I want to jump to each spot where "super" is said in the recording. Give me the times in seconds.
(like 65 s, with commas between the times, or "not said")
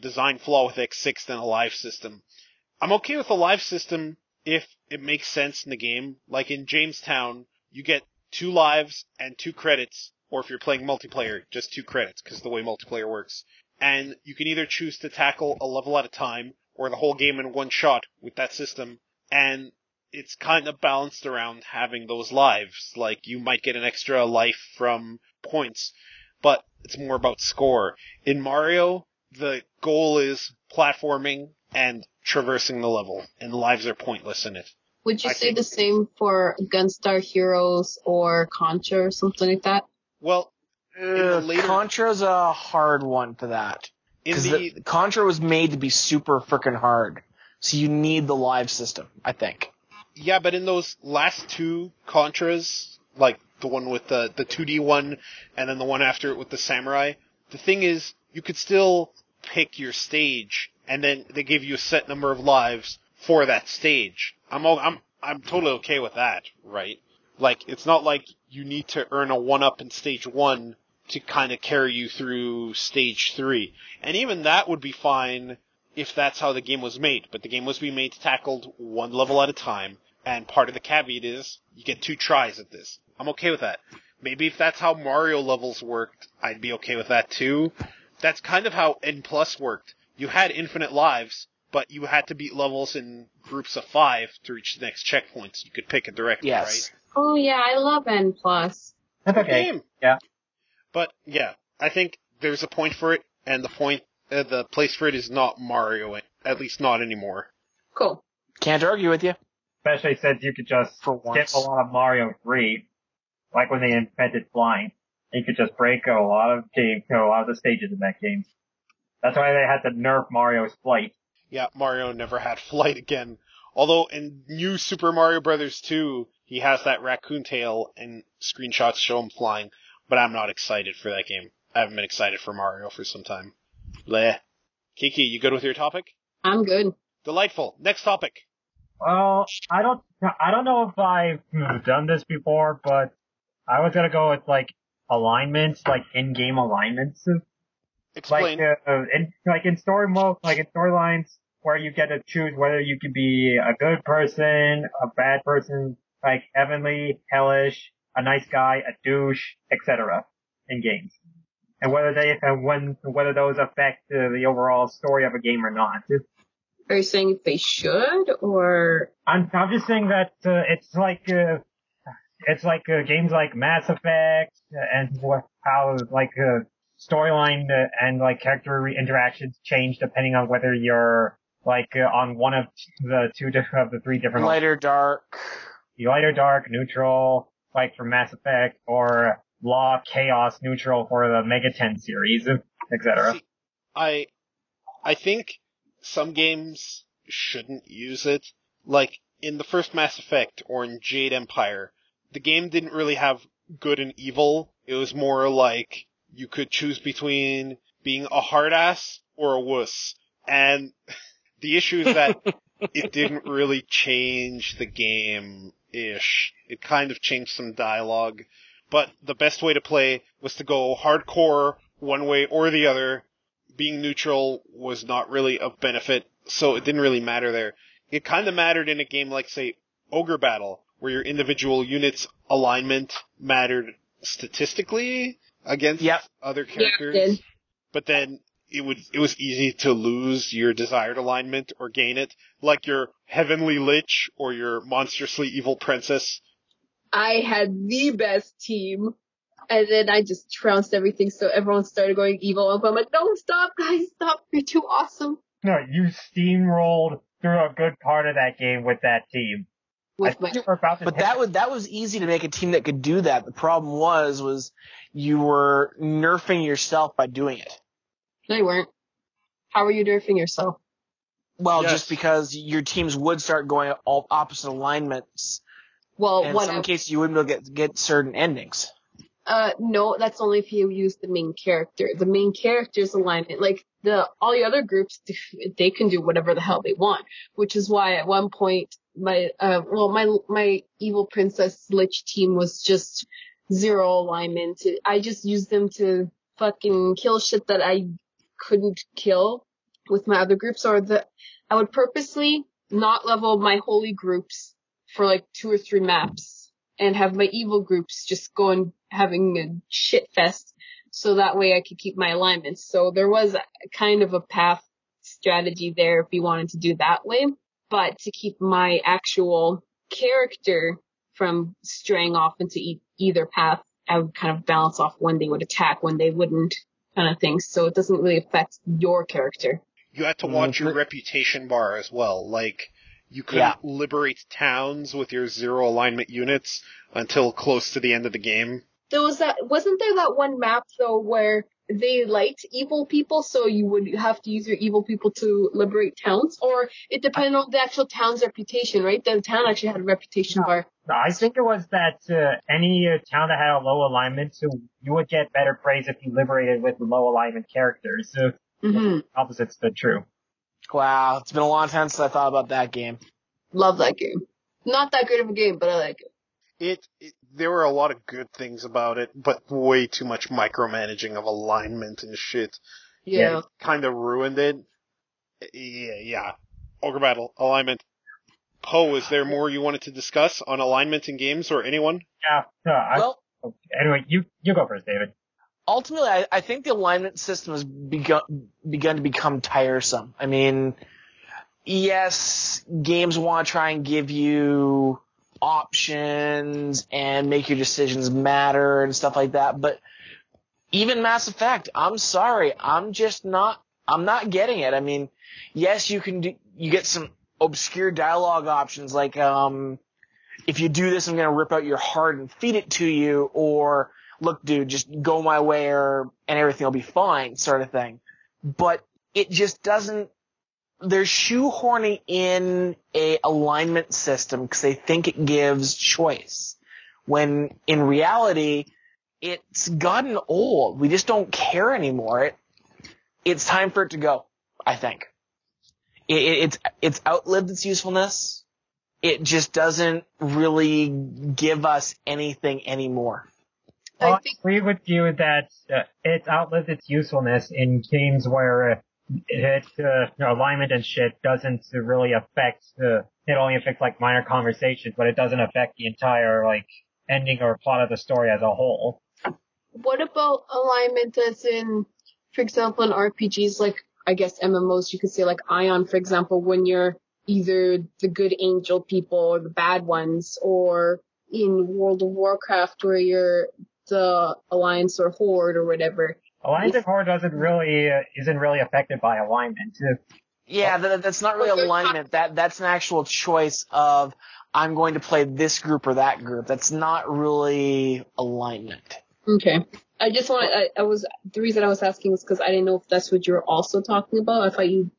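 45 s, 124 s.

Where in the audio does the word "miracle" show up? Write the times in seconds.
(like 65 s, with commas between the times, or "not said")
not said.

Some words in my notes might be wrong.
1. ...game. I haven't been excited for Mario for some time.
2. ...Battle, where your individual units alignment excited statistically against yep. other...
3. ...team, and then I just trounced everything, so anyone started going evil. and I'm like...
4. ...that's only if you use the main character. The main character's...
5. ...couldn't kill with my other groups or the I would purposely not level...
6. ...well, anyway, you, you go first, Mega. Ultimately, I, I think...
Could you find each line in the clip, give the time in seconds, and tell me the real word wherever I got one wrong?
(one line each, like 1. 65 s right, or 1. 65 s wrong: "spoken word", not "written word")
1. 131 s right
2. 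230 s wrong: "mattered", not "excited"
3. 248 s wrong: "everyone", not "anyone"
4. 280 s right
5. 298 s right
6. 383 s wrong: "David", not "Mega".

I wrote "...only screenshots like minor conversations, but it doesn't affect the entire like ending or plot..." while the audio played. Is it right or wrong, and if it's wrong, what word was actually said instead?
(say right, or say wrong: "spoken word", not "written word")
wrong: "affects", not "screenshots".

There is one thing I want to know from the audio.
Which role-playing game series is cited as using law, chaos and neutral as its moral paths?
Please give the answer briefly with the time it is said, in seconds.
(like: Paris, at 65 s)
Mega Ten, at 191 s.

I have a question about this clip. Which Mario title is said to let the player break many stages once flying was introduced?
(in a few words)
Mario 3.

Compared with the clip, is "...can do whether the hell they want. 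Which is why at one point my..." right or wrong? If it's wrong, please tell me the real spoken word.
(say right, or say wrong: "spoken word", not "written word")
wrong: "whatever", not "whether".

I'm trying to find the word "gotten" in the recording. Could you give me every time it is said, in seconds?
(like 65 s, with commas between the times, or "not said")
429 s.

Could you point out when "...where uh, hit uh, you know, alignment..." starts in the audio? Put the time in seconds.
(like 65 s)
448 s.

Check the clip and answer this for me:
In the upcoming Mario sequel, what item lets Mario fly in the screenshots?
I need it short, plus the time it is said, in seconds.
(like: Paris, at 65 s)
raccoon tail, at 127 s.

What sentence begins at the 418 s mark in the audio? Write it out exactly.
But it just doesn't they're shoehorning in a alignment system because they think it gives choice.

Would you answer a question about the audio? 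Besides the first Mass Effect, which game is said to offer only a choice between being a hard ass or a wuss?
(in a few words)
Jade Empire.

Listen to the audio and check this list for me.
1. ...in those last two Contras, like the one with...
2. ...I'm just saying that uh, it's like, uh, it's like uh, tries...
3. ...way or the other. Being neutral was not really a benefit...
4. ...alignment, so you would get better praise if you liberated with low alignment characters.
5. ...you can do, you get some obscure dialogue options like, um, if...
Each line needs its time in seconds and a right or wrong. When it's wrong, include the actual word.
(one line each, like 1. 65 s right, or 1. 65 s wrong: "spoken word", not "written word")
1. 50 s right
2. 169 s wrong: "games", not "tries"
3. 222 s right
4. 354 s right
5. 406 s right.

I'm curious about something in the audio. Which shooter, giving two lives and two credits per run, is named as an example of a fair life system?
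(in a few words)
Jamestown.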